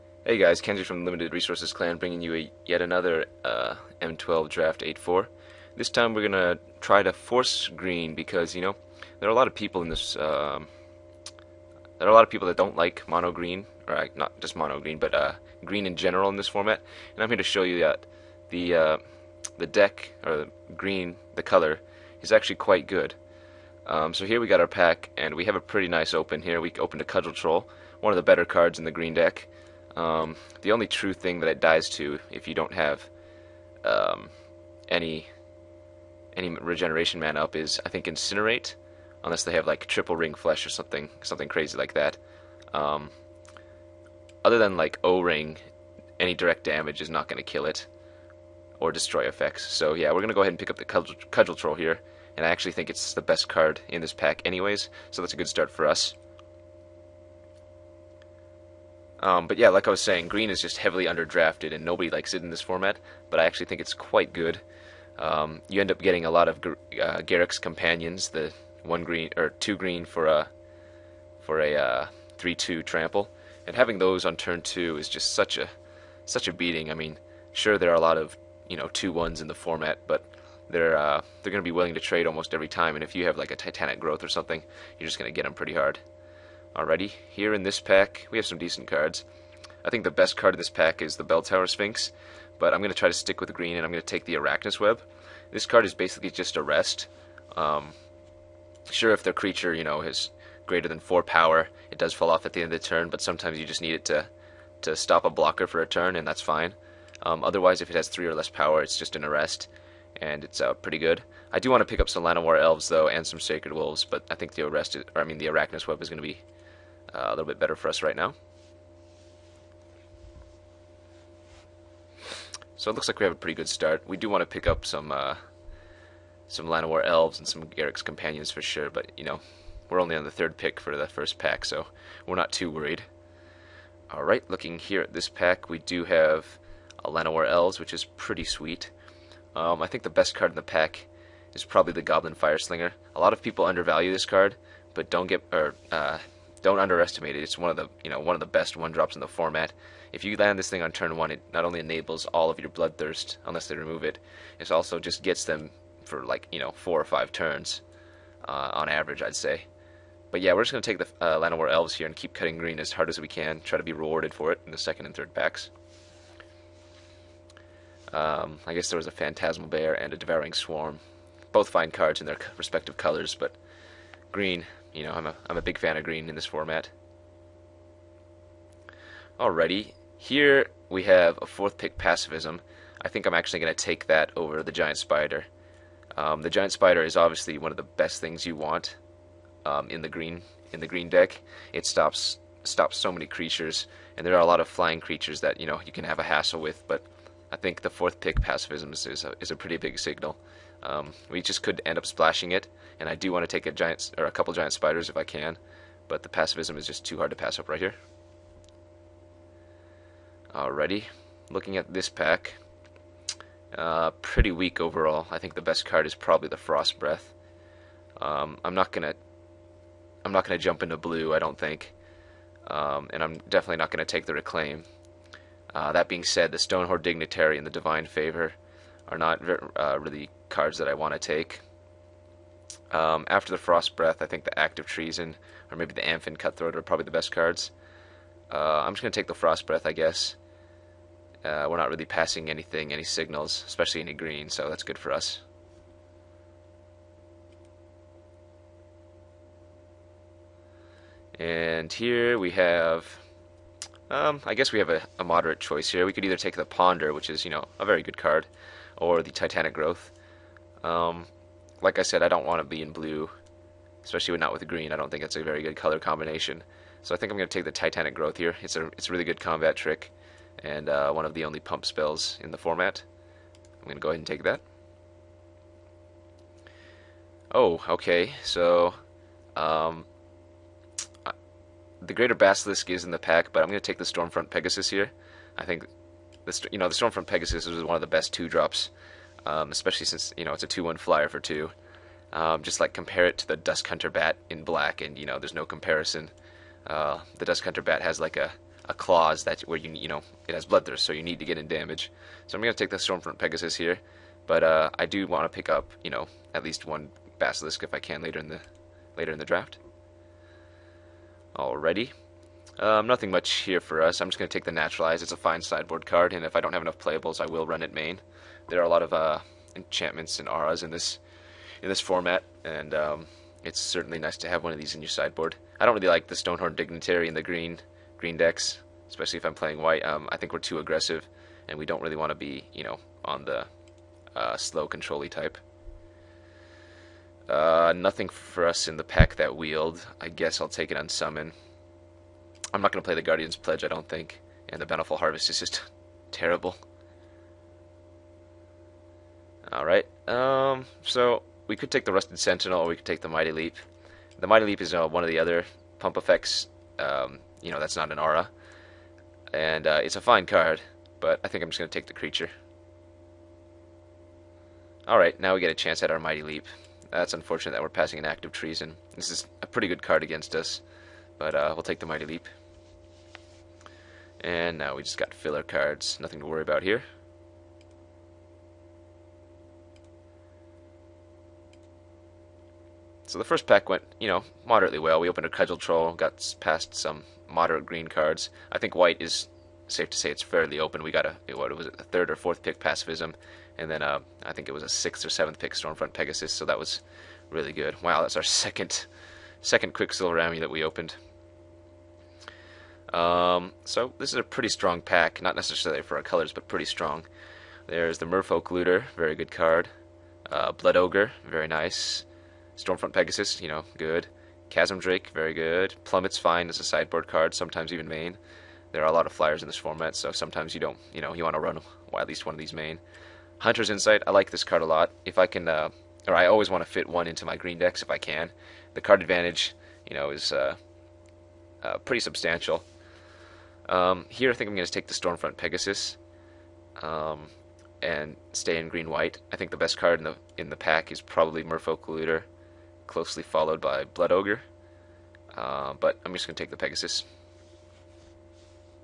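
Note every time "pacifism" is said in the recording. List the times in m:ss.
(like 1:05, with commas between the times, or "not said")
3:01, 3:18, 3:26, 6:32.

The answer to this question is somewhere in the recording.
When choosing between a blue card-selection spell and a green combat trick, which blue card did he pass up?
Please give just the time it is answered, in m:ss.
4:16.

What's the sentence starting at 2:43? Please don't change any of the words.
Try to be rewarded for it in the second and third packs.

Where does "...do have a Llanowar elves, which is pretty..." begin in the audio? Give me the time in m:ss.
2:15.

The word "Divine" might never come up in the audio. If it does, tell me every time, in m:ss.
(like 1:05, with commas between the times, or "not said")
3:47.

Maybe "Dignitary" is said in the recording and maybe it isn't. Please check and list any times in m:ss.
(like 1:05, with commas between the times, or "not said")
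3:47, 5:26.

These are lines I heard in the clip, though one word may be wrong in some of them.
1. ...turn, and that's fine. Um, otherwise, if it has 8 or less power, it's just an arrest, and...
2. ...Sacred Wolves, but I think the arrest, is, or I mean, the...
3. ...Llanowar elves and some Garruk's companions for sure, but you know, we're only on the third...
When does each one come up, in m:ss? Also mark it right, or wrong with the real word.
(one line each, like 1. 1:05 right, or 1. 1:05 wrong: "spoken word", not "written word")
1. 1:45 wrong: "3", not "8"
2. 1:53 right
3. 2:06 right.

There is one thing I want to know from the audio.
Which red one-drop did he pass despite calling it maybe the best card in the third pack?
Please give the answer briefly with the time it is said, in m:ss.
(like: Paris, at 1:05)
Goblin Fireslinger, at 2:22.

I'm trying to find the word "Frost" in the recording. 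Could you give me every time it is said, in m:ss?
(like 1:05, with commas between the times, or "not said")
3:36, 3:53, 3:59.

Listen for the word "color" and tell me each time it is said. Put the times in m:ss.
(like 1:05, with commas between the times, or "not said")
0:21, 2:52, 4:25, 6:46.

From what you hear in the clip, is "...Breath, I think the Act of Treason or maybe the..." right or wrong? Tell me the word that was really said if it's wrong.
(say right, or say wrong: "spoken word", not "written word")
right.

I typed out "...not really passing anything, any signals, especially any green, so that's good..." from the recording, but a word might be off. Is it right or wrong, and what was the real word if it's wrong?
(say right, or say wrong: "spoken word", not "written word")
right.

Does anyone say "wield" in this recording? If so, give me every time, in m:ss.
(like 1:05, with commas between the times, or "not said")
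5:39.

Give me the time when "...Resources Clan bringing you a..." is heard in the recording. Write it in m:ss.
0:01.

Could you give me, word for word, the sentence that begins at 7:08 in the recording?
The card advantage, you know, is uh, uh, pretty substantial.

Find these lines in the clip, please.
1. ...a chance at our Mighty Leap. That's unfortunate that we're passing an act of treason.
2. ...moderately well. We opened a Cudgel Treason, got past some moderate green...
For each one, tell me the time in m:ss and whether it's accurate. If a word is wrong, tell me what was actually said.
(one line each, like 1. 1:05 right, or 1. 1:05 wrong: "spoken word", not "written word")
1. 6:05 right
2. 6:24 wrong: "Troll", not "Treason".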